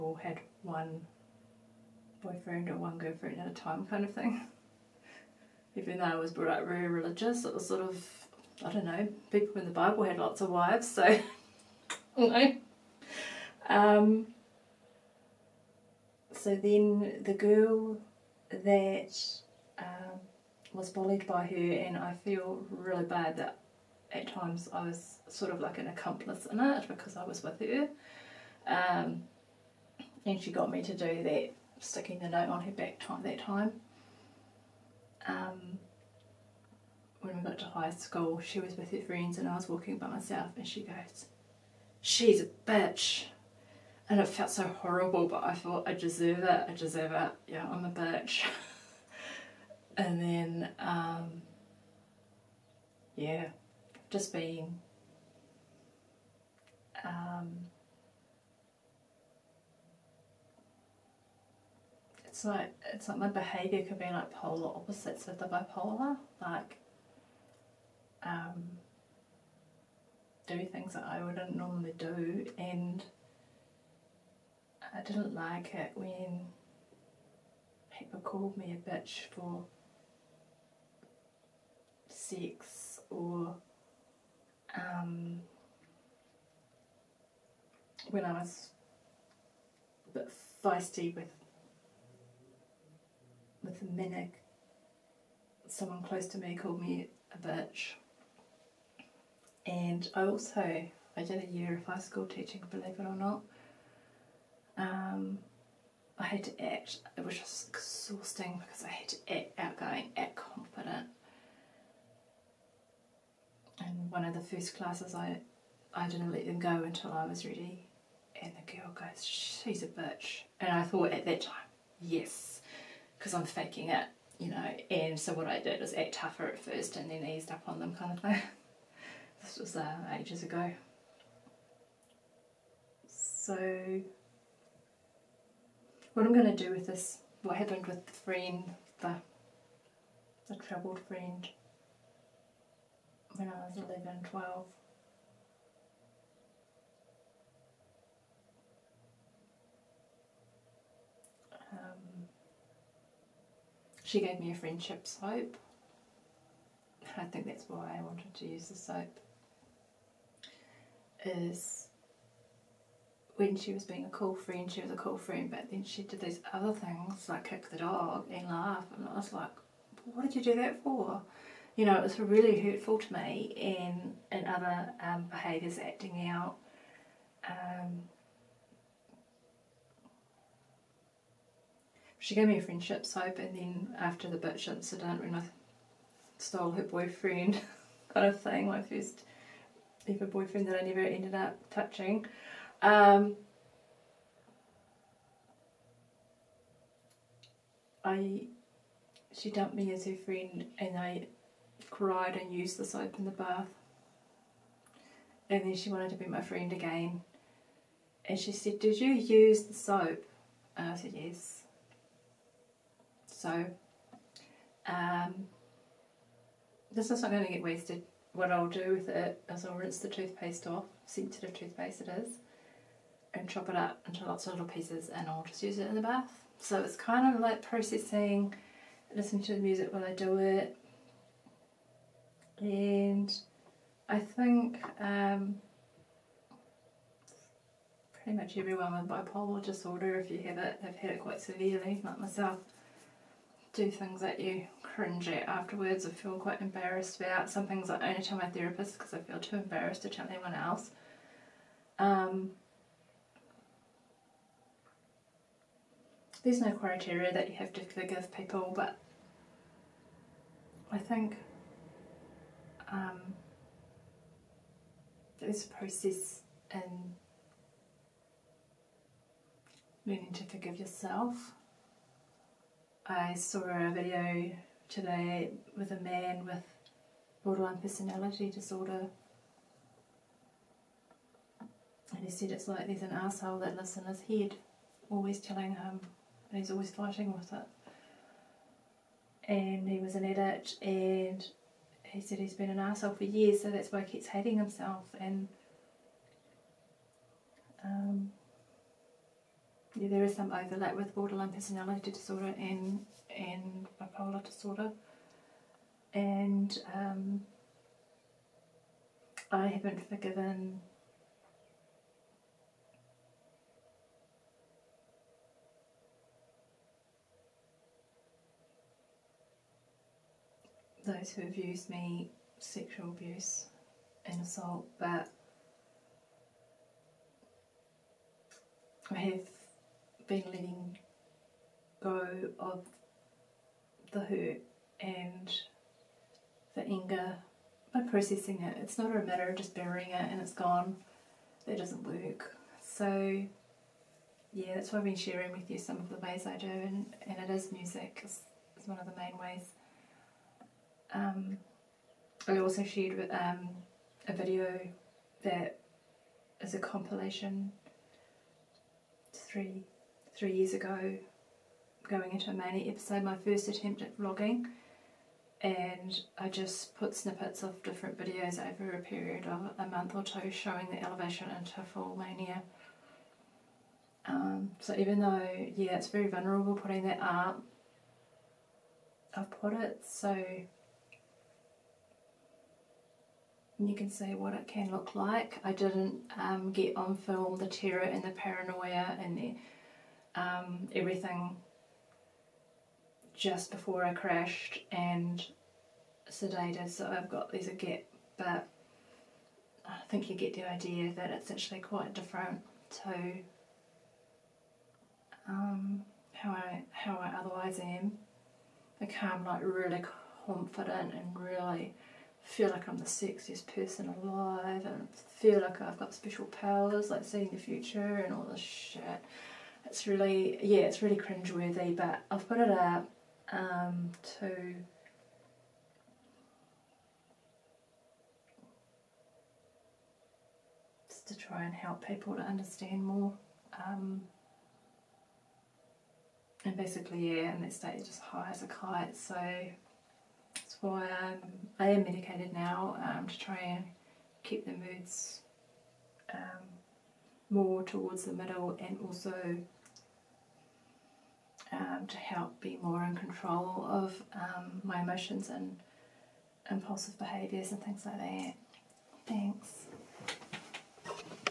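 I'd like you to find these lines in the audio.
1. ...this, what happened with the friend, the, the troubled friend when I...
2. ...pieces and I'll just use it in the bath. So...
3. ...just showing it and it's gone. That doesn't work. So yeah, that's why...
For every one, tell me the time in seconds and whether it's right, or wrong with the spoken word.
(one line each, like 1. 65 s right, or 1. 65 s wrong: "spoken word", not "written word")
1. 136 s right
2. 224 s right
3. 339 s wrong: "burying", not "showing".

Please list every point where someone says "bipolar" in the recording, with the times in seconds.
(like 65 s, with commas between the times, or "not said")
65 s, 239 s, 303 s.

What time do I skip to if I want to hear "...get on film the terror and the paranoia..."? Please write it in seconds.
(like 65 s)
386 s.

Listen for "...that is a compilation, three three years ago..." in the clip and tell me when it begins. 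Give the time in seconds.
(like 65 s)
355 s.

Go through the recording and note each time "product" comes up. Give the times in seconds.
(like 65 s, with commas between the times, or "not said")
not said.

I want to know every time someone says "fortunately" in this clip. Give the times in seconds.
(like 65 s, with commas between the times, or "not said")
not said.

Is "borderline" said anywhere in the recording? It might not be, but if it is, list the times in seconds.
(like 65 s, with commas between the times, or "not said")
277 s, 301 s.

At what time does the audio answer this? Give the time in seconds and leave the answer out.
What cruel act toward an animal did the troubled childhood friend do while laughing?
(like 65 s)
167 s.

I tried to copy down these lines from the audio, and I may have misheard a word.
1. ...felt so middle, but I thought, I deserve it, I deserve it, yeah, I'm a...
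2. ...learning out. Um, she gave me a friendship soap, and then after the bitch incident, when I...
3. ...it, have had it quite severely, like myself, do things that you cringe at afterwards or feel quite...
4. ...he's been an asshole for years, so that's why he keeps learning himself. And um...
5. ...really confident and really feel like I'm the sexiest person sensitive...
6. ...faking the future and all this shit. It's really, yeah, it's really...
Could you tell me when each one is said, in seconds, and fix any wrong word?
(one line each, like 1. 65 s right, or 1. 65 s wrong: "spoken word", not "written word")
1. 44 s wrong: "horrible", not "middle"
2. 175 s wrong: "acting", not "learning"
3. 240 s right
4. 292 s wrong: "hating", not "learning"
5. 409 s wrong: "alive", not "sensitive"
6. 417 s wrong: "seeing", not "faking".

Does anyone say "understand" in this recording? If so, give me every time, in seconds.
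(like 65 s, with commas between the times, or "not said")
432 s.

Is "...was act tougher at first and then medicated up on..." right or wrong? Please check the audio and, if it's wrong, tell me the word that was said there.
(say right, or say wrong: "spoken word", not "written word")
wrong: "eased", not "medicated".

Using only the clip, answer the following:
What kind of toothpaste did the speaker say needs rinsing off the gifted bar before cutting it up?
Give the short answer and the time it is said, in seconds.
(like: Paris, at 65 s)
Sensitive toothpaste, at 221 s.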